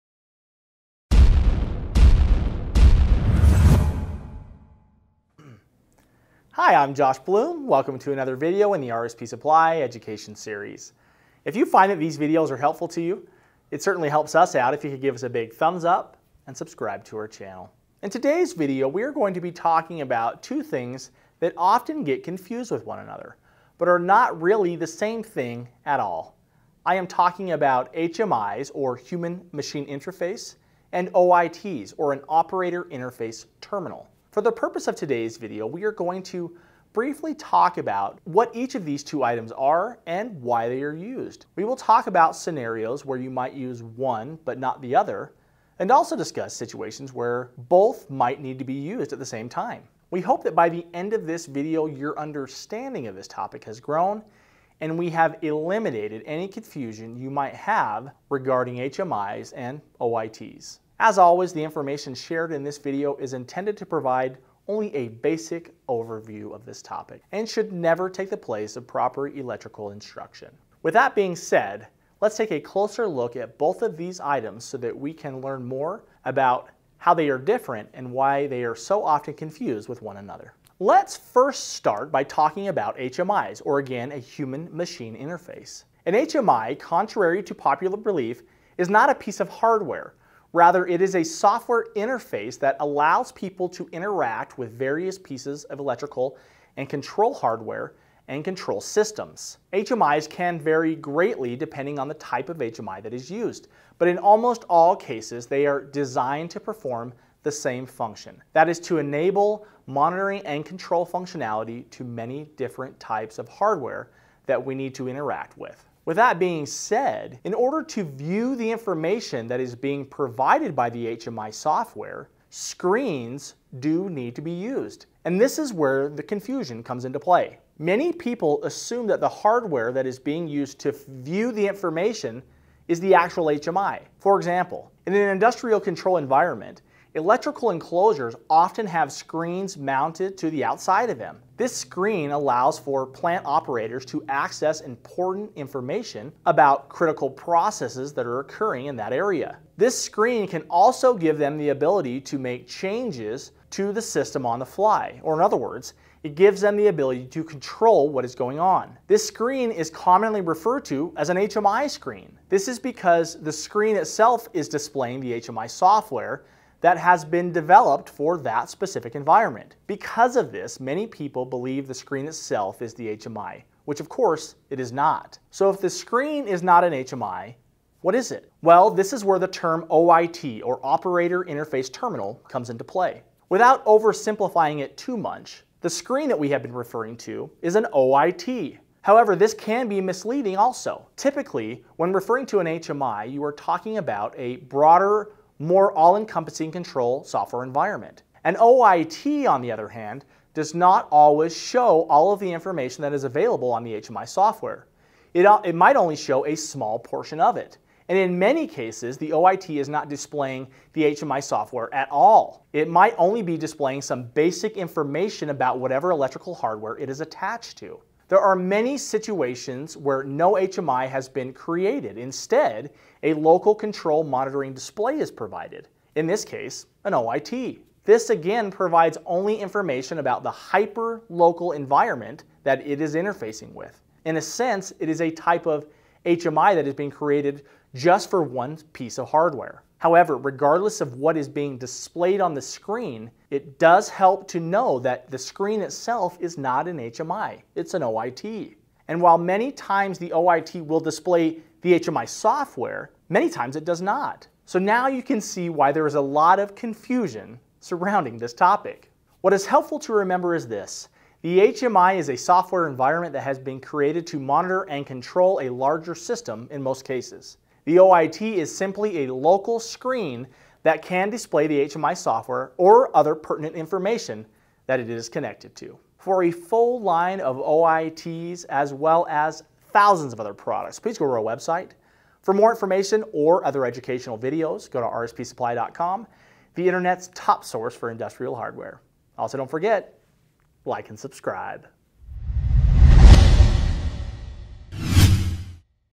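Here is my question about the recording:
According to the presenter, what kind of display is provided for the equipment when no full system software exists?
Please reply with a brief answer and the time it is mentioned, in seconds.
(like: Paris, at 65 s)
local control monitoring display, at 223 s.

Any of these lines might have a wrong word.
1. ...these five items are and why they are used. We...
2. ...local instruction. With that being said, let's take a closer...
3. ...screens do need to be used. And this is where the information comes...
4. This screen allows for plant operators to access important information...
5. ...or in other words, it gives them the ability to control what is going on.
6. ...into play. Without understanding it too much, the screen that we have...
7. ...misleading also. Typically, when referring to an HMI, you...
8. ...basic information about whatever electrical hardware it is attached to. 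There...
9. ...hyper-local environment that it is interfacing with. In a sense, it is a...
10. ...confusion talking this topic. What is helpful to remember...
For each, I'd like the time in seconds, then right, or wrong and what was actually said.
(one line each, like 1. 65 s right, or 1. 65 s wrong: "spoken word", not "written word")
1. 38 s wrong: "two", not "five"
2. 69 s wrong: "electrical", not "local"
3. 122 s wrong: "confusion", not "information"
4. 141 s right
5. 155 s right
6. 182 s wrong: "oversimplifying", not "understanding"
7. 190 s right
8. 214 s right
9. 230 s right
10. 256 s wrong: "surrounding", not "talking".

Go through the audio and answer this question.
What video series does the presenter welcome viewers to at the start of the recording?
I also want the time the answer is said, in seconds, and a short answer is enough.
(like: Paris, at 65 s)
RSP Supply Education Series, at 8 s.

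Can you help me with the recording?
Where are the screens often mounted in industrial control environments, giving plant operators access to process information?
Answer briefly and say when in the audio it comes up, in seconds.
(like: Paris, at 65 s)
electrical enclosures, at 137 s.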